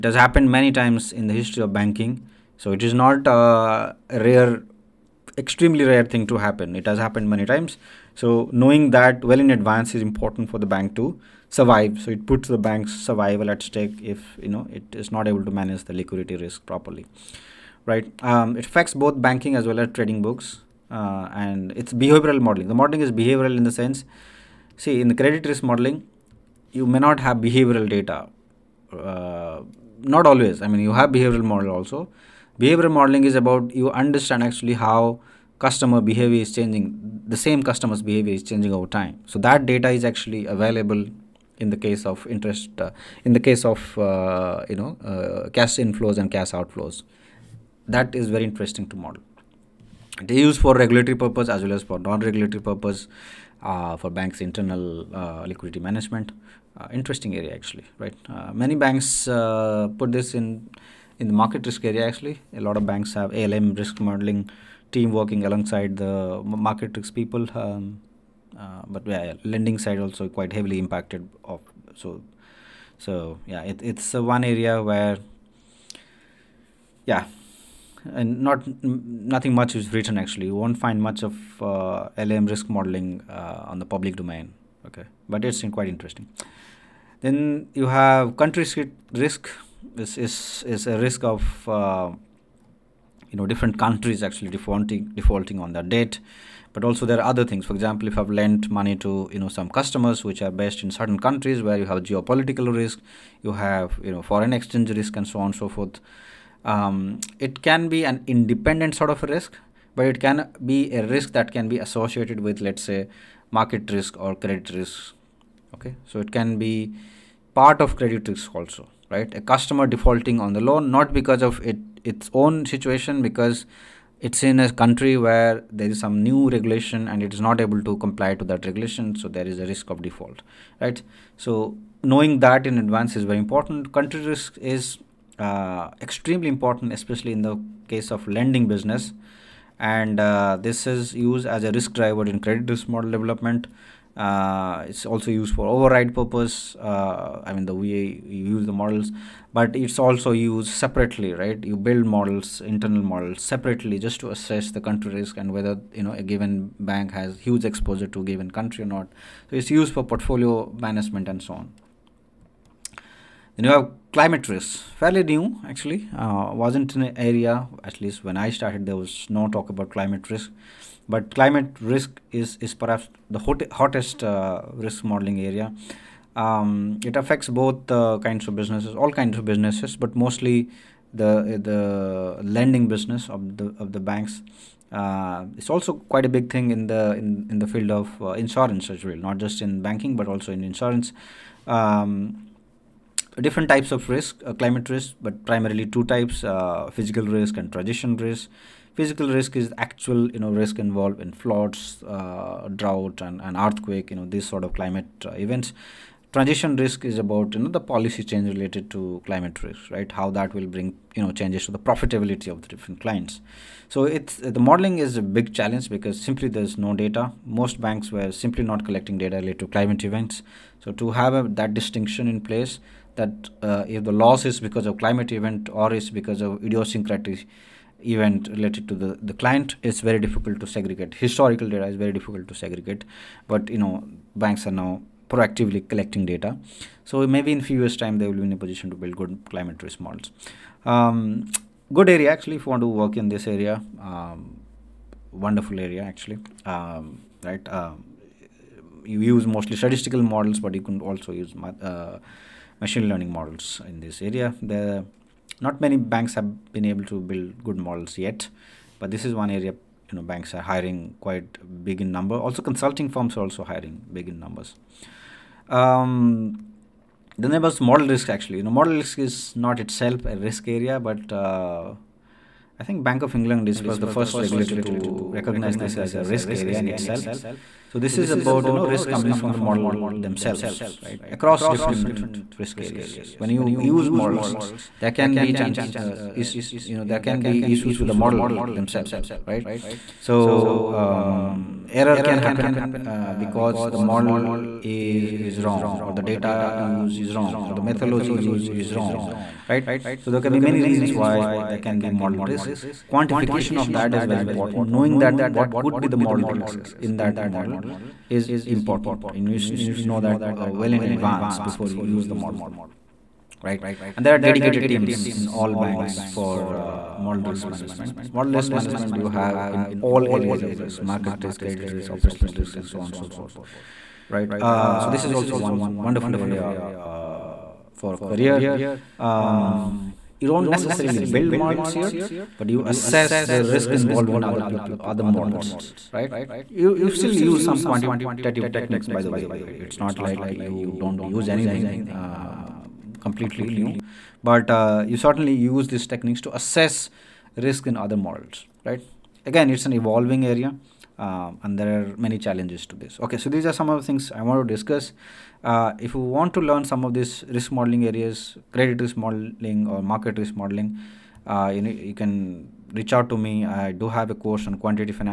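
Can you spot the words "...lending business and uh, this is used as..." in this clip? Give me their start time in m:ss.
2:18.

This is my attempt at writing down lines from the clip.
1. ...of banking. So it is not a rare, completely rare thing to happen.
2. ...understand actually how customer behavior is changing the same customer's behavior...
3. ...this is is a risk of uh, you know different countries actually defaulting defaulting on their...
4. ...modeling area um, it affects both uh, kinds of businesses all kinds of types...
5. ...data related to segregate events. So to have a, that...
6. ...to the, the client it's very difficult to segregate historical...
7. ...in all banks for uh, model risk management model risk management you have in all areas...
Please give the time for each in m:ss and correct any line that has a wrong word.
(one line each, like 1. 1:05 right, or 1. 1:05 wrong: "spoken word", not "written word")
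1. 0:01 wrong: "extremely", not "completely"
2. 0:33 right
3. 1:29 right
4. 2:55 wrong: "businesses", not "types"
5. 3:39 wrong: "climate", not "segregate"
6. 3:48 right
7. 5:15 right.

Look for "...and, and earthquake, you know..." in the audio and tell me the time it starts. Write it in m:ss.
3:23.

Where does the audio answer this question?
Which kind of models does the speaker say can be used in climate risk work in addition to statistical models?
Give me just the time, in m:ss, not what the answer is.
4:12.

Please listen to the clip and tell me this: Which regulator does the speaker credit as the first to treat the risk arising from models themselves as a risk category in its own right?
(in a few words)
Bank of England.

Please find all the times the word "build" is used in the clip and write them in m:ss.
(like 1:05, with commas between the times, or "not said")
2:31, 3:58, 4:17, 5:31.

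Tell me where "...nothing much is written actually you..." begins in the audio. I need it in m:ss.
1:18.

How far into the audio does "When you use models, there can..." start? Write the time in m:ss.
4:43.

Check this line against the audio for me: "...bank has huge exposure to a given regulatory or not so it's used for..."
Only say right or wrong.
wrong.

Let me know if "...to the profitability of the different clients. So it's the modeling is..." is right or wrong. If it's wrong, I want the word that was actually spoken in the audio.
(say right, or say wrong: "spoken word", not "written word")
right.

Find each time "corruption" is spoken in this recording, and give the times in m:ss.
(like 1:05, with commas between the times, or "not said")
not said.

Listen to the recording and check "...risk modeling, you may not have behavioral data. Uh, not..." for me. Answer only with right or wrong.
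right.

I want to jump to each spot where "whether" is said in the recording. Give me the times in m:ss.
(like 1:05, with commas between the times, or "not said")
2:35.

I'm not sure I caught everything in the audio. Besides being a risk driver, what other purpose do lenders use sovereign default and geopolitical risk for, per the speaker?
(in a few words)
Override purpose.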